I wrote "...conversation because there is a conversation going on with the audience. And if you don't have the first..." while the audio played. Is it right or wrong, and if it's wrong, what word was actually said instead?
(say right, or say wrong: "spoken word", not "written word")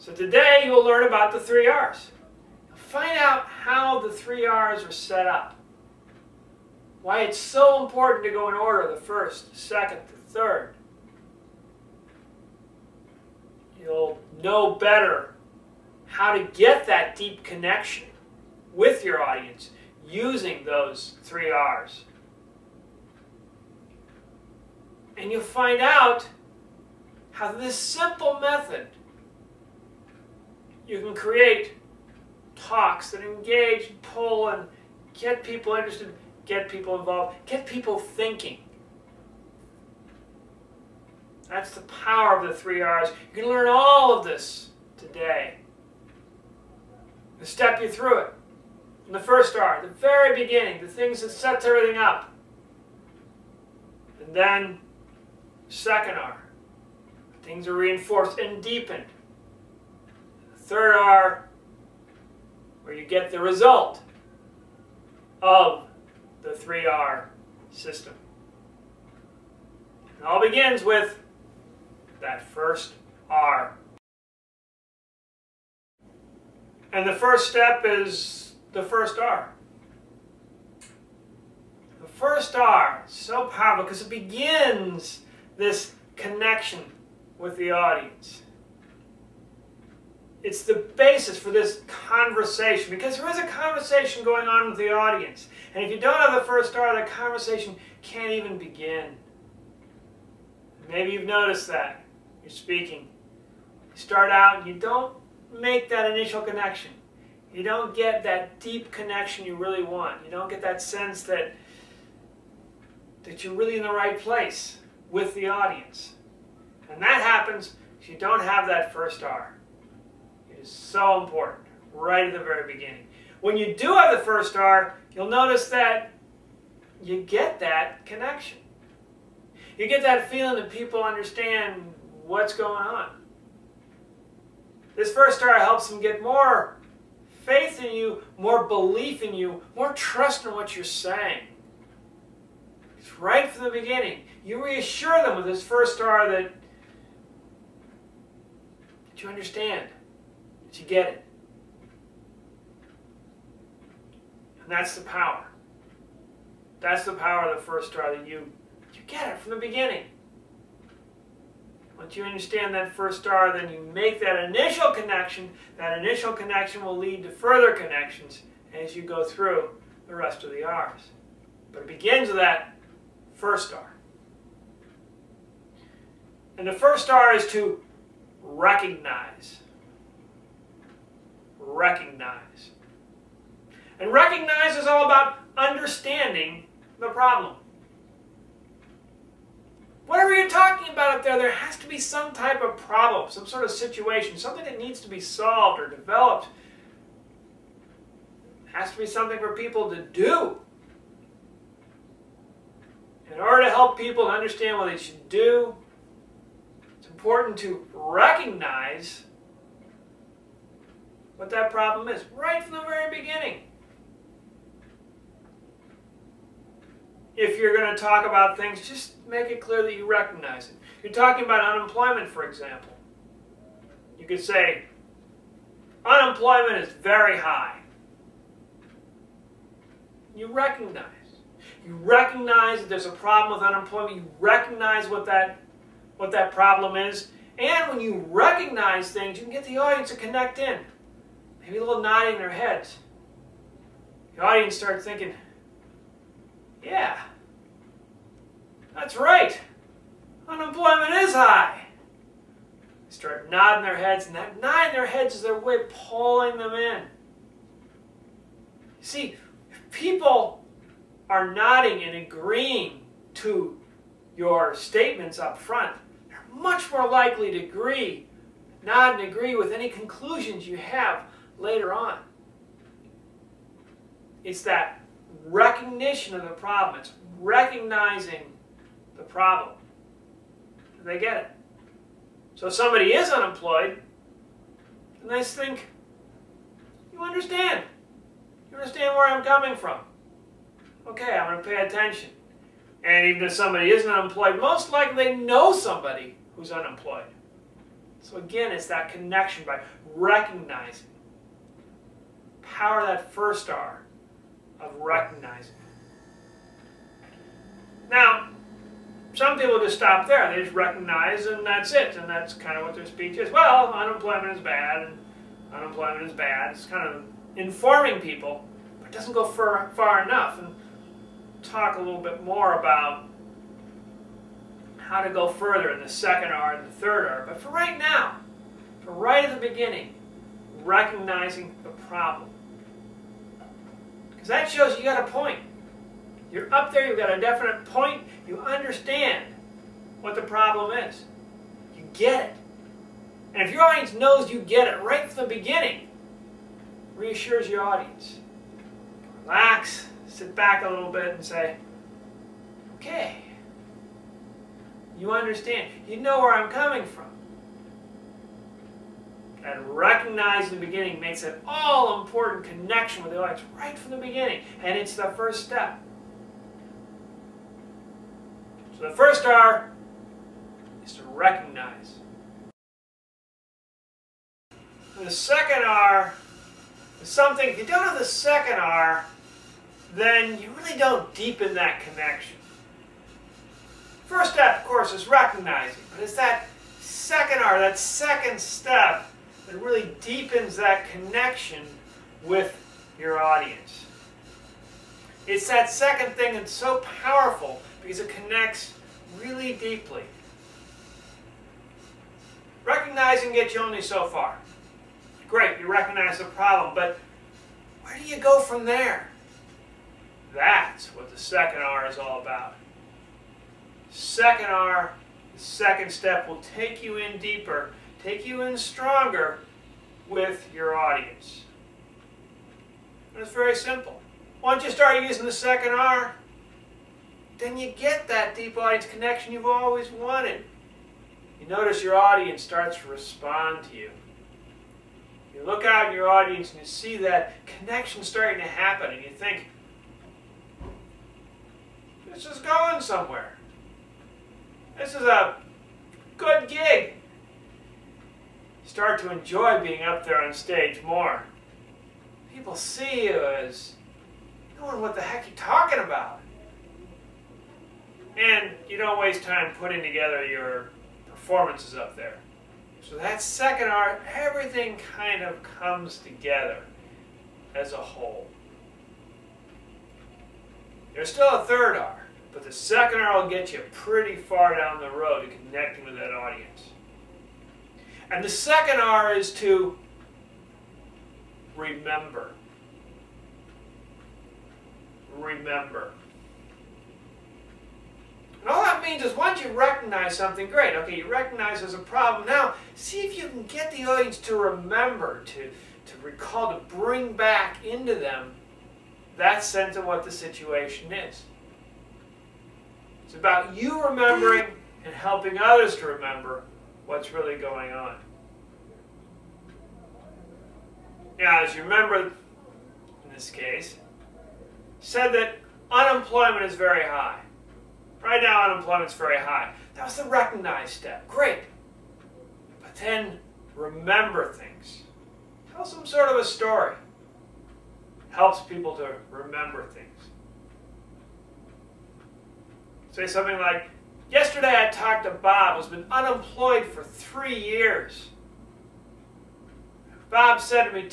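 right.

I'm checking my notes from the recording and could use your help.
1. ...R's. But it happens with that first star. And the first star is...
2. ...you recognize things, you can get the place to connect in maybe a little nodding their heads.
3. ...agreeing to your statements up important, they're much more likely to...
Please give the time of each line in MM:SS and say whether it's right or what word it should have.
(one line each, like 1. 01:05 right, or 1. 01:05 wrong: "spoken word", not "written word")
1. 02:50 wrong: "begins", not "happens"
2. 03:57 wrong: "audience", not "place"
3. 04:22 wrong: "front", not "important".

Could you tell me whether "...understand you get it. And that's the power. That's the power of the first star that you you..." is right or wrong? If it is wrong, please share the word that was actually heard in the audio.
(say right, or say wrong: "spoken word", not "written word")
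right.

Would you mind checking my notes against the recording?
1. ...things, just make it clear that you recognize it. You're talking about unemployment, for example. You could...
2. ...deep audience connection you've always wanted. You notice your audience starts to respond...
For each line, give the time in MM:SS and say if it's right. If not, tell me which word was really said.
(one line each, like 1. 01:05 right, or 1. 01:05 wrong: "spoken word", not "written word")
1. 03:38 right
2. 07:08 right.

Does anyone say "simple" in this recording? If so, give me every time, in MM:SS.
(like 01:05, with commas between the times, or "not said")
00:27, 07:03.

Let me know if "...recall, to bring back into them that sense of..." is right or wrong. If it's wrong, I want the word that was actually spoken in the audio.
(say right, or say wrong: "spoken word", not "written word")
right.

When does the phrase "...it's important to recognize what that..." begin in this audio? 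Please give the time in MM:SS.
03:26.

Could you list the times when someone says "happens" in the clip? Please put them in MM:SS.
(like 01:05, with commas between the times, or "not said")
01:57, 07:18.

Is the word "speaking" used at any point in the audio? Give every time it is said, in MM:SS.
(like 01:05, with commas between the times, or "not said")
01:42.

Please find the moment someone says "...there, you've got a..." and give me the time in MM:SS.
05:36.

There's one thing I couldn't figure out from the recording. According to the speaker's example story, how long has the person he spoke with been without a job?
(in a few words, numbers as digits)
3 years.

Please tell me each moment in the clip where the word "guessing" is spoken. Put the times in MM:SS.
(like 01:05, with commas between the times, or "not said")
not said.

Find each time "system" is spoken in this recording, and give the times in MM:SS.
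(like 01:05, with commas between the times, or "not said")
01:07.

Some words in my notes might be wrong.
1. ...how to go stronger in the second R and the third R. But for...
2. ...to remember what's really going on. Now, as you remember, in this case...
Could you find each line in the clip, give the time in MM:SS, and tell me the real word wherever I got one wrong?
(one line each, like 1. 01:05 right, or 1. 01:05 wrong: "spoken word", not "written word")
1. 05:24 wrong: "further", not "stronger"
2. 08:25 right.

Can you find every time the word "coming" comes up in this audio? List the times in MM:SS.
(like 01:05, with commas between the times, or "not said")
04:49, 05:56.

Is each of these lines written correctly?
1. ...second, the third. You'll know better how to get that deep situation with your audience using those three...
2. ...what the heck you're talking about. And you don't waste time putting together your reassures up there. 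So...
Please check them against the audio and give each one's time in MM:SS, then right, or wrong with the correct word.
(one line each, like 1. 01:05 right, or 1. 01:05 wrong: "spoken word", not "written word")
1. 00:09 wrong: "connection", not "situation"
2. 07:35 wrong: "performances", not "reassures".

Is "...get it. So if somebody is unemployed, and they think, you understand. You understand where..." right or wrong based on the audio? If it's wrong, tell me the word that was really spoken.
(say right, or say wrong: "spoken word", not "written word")
right.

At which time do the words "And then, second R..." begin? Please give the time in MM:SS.
00:54.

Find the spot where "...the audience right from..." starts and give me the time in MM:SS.
06:03.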